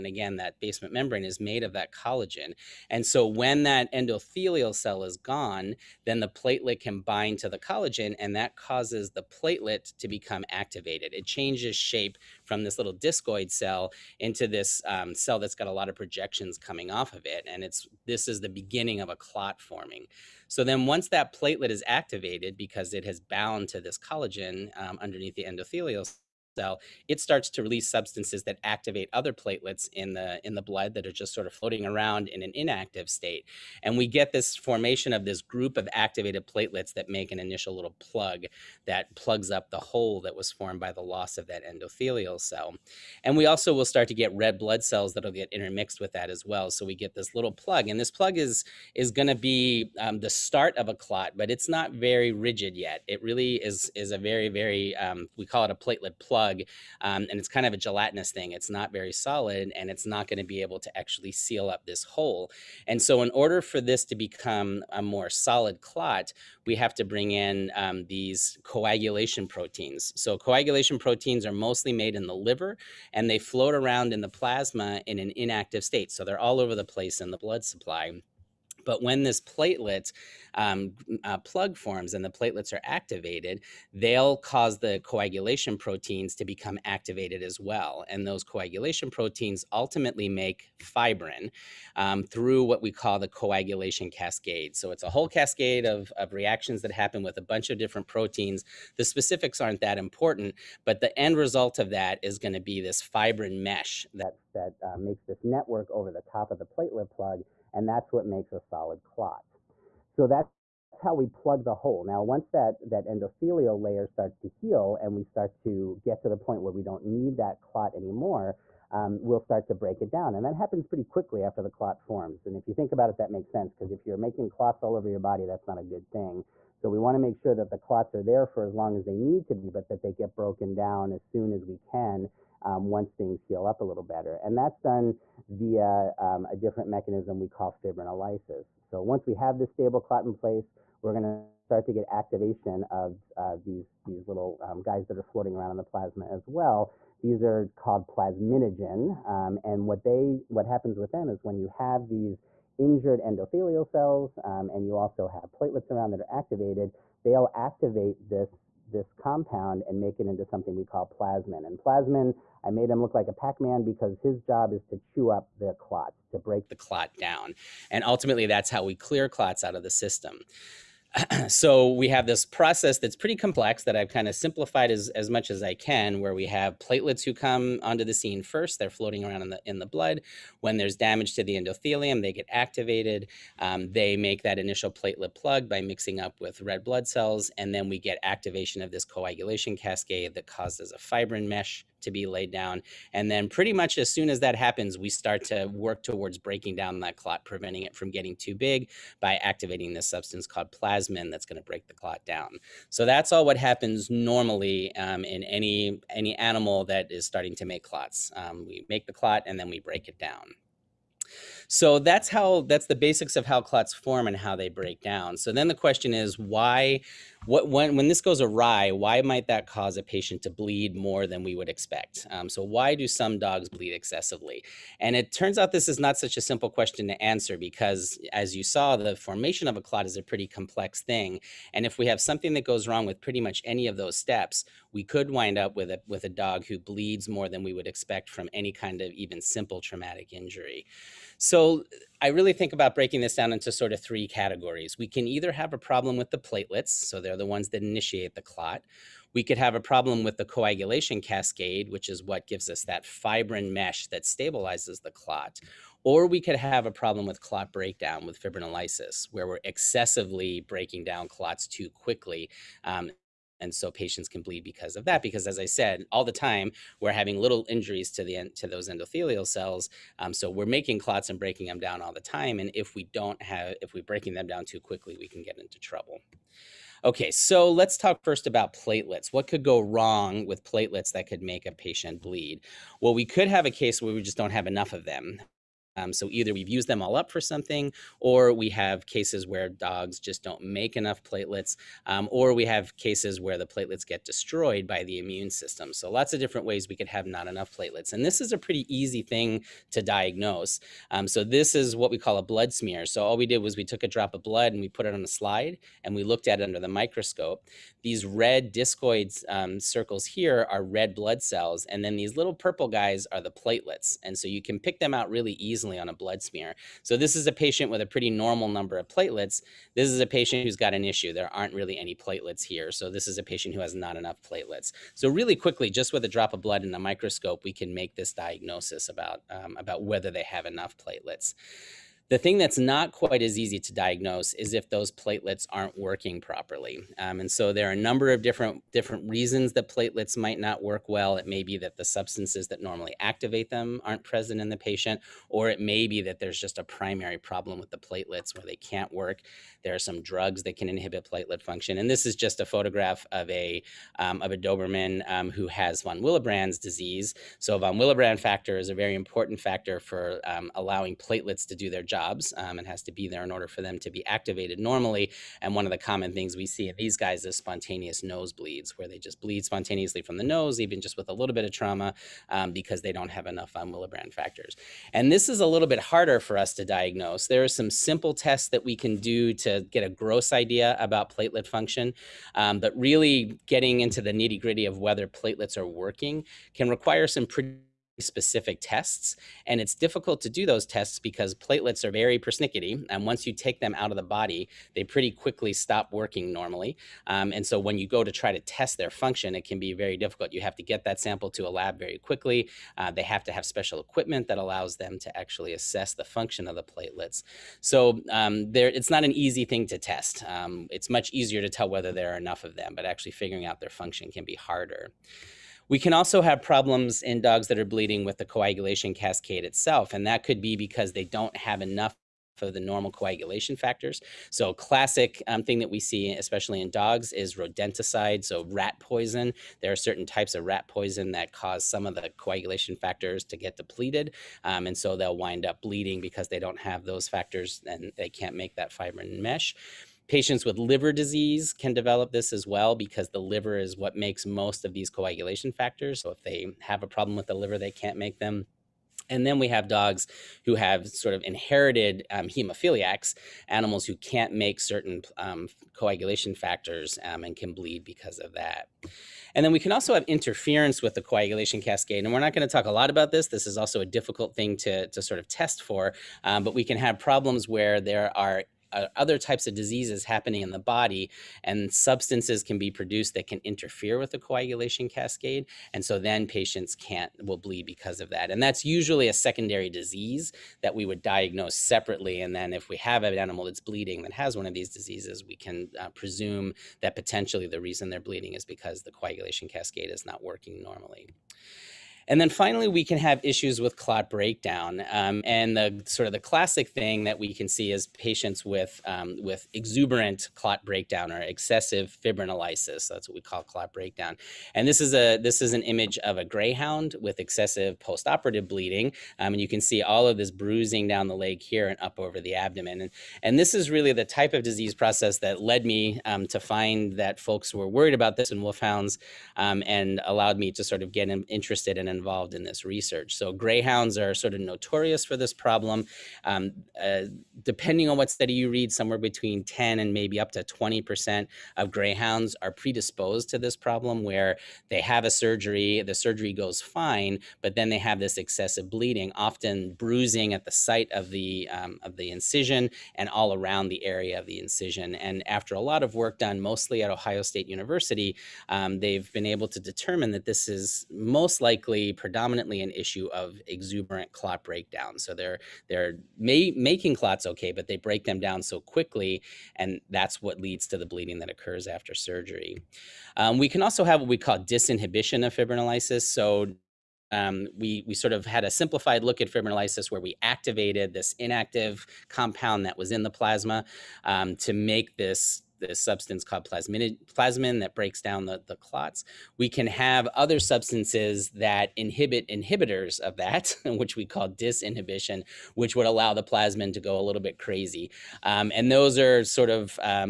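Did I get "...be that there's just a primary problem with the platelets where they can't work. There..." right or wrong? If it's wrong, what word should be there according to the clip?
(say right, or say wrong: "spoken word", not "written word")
right.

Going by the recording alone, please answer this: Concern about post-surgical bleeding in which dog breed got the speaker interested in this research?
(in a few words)
Wolfhounds.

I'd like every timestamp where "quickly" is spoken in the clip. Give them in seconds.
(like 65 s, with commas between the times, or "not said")
121 s, 261 s, 274 s, 325 s, 395 s, 402 s, 558 s.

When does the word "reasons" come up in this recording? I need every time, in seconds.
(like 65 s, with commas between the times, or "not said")
339 s, 487 s.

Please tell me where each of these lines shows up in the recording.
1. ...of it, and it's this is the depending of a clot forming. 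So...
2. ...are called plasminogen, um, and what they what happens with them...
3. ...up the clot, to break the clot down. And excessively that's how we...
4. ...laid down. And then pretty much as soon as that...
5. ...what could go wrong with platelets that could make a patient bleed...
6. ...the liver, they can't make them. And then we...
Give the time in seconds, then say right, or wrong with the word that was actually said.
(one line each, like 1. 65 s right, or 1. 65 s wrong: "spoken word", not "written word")
1. 17 s wrong: "beginning", not "depending"
2. 147 s right
3. 165 s wrong: "ultimately", not "excessively"
4. 192 s right
5. 279 s right
6. 447 s right.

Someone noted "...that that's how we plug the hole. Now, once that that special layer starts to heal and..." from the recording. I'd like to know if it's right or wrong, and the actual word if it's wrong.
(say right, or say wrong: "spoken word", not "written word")
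wrong: "endothelial", not "special".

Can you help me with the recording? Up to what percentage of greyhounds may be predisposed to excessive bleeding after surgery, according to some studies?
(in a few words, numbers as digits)
20%.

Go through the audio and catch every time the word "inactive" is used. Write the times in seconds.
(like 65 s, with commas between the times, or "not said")
32 s, 75 s, 571 s.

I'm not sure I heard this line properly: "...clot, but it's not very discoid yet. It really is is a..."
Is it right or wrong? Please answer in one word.
wrong.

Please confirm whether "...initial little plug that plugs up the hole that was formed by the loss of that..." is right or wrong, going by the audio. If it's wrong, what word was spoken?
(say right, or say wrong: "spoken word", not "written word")
right.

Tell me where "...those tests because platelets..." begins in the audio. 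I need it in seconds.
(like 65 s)
390 s.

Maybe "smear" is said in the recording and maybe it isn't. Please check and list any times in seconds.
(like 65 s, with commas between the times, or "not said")
302 s, 316 s.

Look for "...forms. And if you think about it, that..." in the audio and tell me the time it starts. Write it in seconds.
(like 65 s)
122 s.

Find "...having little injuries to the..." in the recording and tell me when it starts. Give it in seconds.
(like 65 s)
267 s.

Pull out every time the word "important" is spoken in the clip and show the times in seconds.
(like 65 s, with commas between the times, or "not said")
99 s, 359 s.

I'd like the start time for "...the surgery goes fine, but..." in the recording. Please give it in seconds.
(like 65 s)
536 s.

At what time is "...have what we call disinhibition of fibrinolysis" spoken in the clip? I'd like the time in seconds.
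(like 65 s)
564 s.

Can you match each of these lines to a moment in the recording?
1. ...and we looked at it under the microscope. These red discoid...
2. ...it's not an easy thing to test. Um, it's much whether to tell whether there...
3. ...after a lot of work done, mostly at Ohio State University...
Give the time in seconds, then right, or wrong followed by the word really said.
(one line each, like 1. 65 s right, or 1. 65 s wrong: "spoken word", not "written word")
1. 306 s right
2. 408 s wrong: "easier", not "whether"
3. 545 s right.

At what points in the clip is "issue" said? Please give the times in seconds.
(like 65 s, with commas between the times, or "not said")
321 s, 493 s, 552 s.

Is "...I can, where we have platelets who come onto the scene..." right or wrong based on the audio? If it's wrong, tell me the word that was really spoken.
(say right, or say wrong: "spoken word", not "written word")
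right.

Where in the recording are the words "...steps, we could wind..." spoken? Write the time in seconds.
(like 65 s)
234 s.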